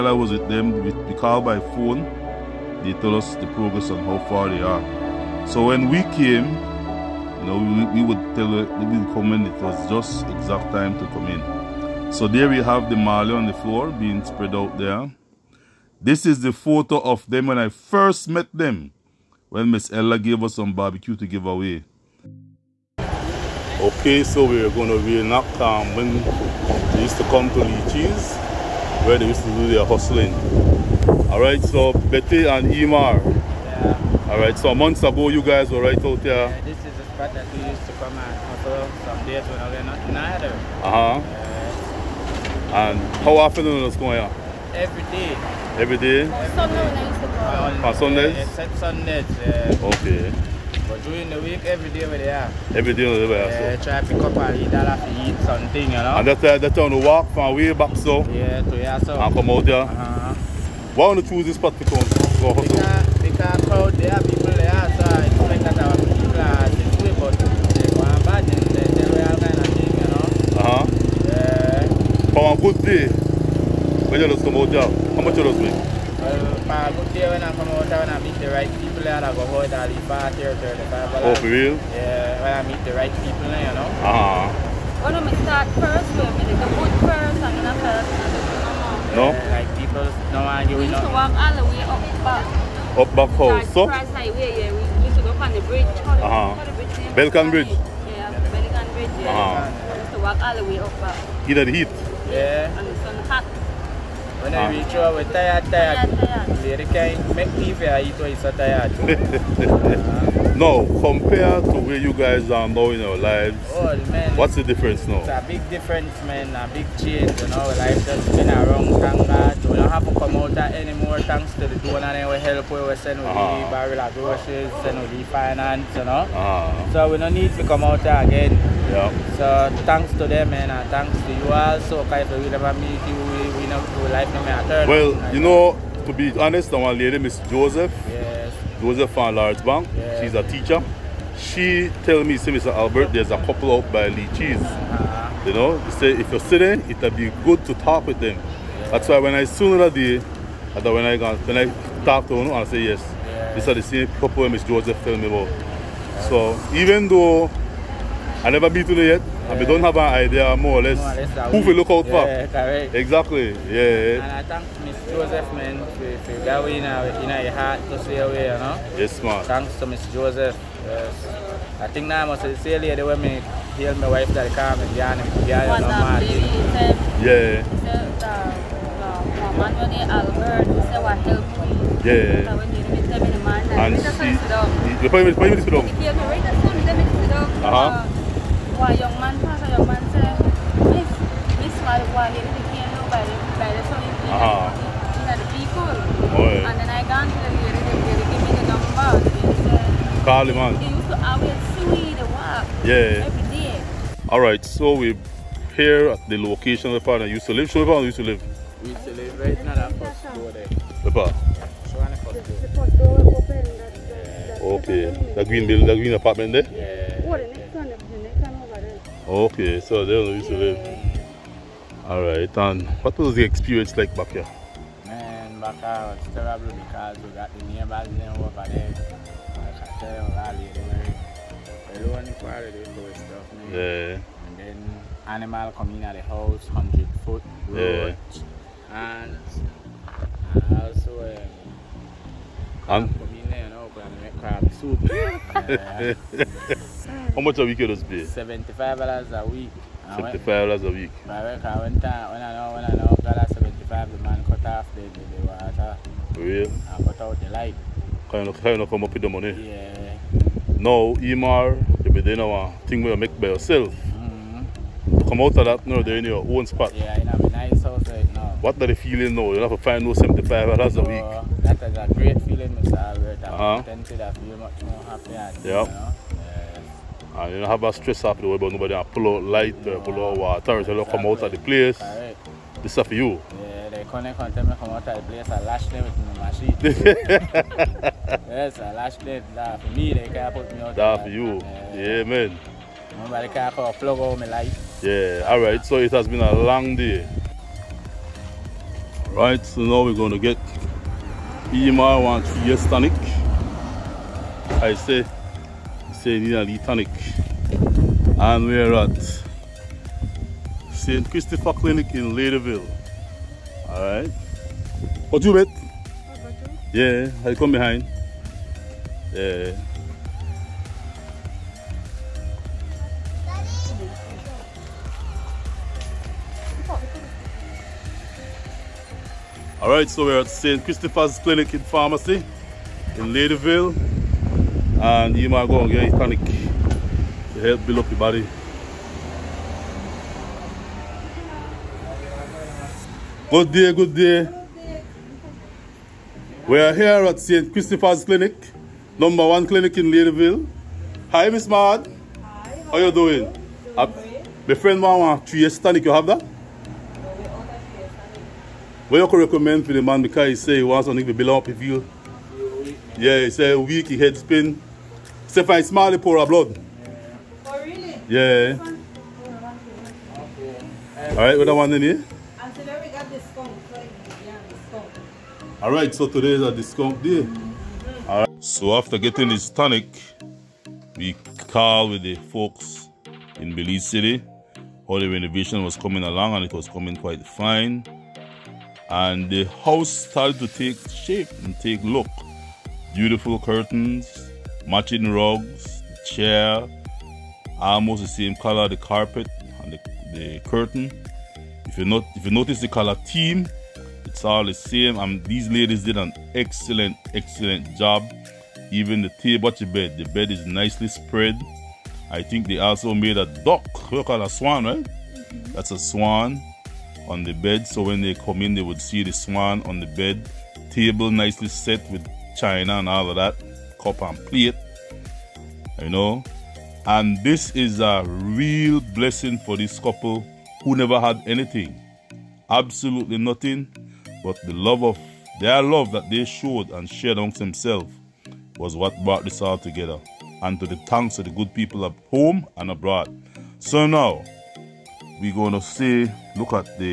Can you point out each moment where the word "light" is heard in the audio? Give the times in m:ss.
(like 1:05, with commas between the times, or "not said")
4:17, 4:39.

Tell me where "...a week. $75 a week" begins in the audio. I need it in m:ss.
4:09.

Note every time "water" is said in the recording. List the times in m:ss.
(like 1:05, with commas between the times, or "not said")
4:15, 4:40.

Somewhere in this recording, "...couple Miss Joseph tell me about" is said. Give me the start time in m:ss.
2:34.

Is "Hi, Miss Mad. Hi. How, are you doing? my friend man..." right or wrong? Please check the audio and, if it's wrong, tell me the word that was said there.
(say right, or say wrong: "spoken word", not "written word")
right.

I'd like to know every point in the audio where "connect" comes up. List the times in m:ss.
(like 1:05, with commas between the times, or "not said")
4:44.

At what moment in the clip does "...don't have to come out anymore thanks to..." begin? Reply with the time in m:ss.
1:59.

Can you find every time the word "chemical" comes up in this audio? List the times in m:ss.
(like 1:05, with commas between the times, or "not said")
not said.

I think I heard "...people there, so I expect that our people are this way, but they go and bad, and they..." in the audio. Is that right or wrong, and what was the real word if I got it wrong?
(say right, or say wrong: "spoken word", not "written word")
right.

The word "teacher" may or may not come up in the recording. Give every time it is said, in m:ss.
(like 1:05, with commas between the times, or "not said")
2:20.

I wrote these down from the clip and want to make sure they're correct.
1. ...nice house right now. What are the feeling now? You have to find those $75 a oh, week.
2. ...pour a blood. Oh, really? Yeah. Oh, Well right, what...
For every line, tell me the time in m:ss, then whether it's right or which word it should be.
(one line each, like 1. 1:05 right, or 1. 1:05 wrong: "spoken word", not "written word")
1. 4:27 right
2. 6:06 wrong: "All", not "Well".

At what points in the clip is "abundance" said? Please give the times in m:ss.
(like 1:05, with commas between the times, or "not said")
not said.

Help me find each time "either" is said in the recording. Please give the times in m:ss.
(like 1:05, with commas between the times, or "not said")
0:40, 1:41.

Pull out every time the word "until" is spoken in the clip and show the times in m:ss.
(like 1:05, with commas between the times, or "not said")
4:44.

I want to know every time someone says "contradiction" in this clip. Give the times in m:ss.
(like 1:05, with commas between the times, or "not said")
not said.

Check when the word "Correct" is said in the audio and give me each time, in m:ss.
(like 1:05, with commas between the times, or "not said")
2:42, 4:41.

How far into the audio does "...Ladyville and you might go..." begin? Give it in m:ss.
5:33.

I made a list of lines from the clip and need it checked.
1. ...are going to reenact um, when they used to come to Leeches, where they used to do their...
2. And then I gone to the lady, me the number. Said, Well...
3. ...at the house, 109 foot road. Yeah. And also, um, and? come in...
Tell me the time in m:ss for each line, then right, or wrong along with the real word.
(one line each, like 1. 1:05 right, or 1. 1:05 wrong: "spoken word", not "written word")
1. 0:24 right
2. 3:16 wrong: "Call", not "Well"
3. 3:56 wrong: "100", not "109".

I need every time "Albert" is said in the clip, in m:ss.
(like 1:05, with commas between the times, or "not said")
2:22.